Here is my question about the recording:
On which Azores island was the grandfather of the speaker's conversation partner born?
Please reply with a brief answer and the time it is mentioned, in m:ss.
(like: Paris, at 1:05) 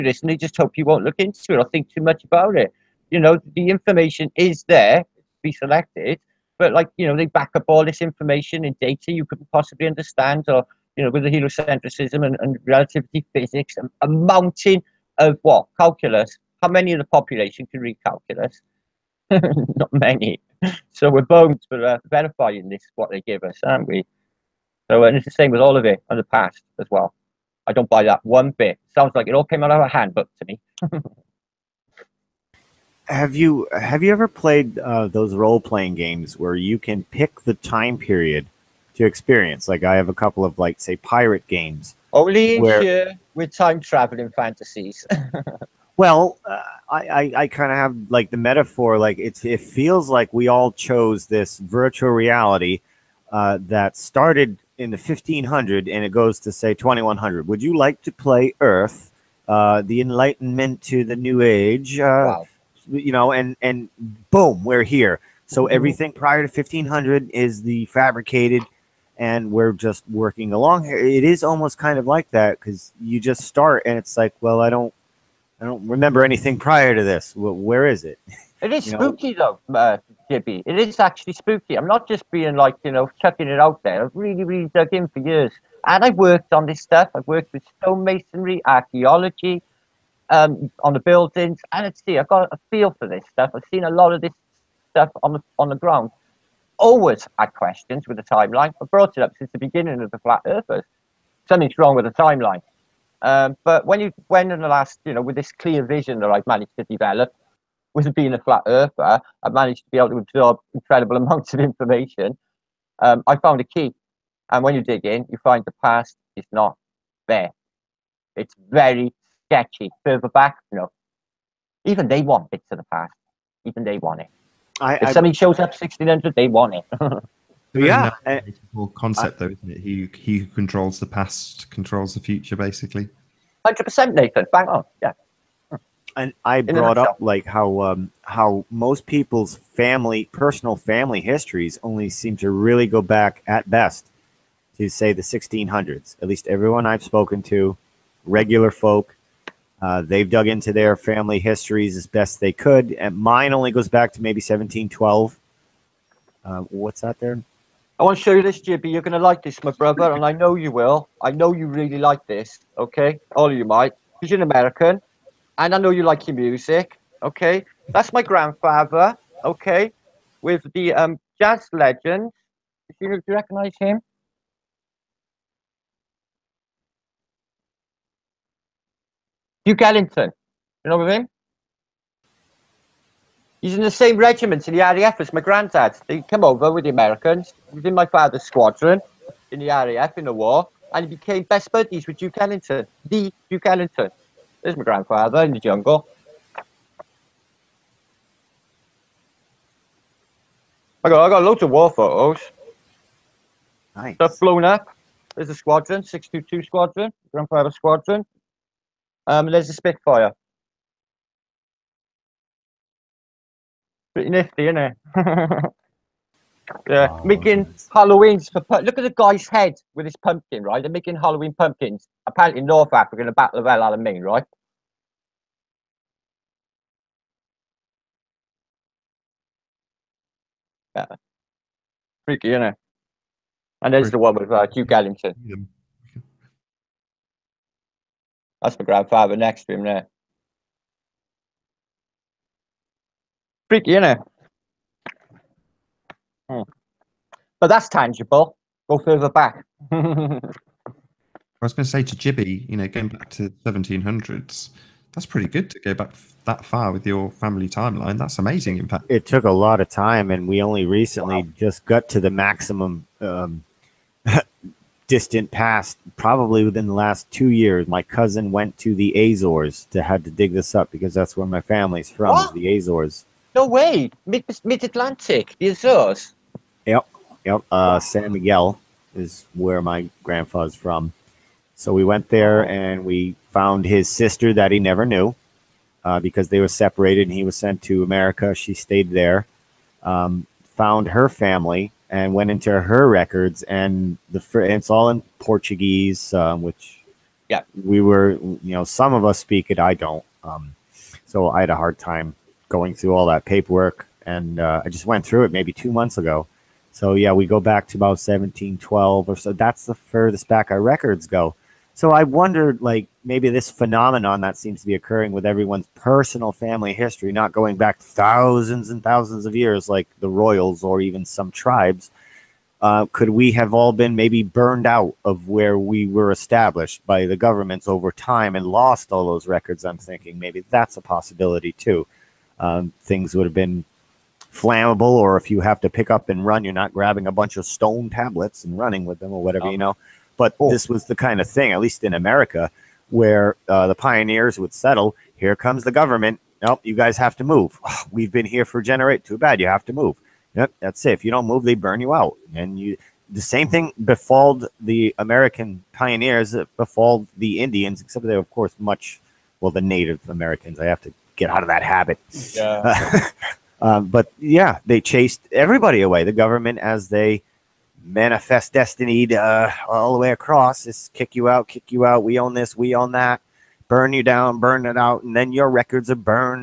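San Miguel, at 4:37.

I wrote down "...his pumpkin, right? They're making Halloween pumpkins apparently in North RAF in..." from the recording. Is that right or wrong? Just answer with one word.
wrong.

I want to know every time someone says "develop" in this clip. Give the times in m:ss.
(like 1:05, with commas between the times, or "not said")
1:46.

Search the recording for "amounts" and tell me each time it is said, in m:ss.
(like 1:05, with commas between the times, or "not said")
1:51.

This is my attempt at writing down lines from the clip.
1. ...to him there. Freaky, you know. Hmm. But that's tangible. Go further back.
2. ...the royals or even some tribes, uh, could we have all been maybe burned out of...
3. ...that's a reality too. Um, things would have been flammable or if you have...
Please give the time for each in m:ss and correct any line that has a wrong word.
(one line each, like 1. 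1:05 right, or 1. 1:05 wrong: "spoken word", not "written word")
1. 3:59 right
2. 5:20 right
3. 5:30 wrong: "possibility", not "reality".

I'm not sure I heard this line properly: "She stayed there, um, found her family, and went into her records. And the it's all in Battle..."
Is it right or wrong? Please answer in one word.
wrong.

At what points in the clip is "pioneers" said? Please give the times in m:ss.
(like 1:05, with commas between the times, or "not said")
5:43, 5:55.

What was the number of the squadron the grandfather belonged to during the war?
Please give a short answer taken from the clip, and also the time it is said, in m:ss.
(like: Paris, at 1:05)
622, at 3:26.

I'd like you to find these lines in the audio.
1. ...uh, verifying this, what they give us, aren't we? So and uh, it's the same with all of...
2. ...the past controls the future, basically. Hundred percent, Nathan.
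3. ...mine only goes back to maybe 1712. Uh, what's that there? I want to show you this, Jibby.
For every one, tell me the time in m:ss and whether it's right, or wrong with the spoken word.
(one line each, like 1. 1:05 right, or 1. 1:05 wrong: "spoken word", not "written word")
1. 0:21 right
2. 2:10 right
3. 2:33 right.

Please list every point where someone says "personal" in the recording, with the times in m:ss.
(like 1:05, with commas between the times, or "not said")
2:20, 5:15.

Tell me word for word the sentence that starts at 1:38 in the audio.
I've brought it up since the beginning of the Flat Earthers.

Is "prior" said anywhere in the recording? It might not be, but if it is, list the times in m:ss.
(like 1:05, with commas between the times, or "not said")
1:06, 1:16.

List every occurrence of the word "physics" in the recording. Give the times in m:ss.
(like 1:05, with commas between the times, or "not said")
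0:13.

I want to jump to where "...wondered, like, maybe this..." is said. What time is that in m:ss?
5:12.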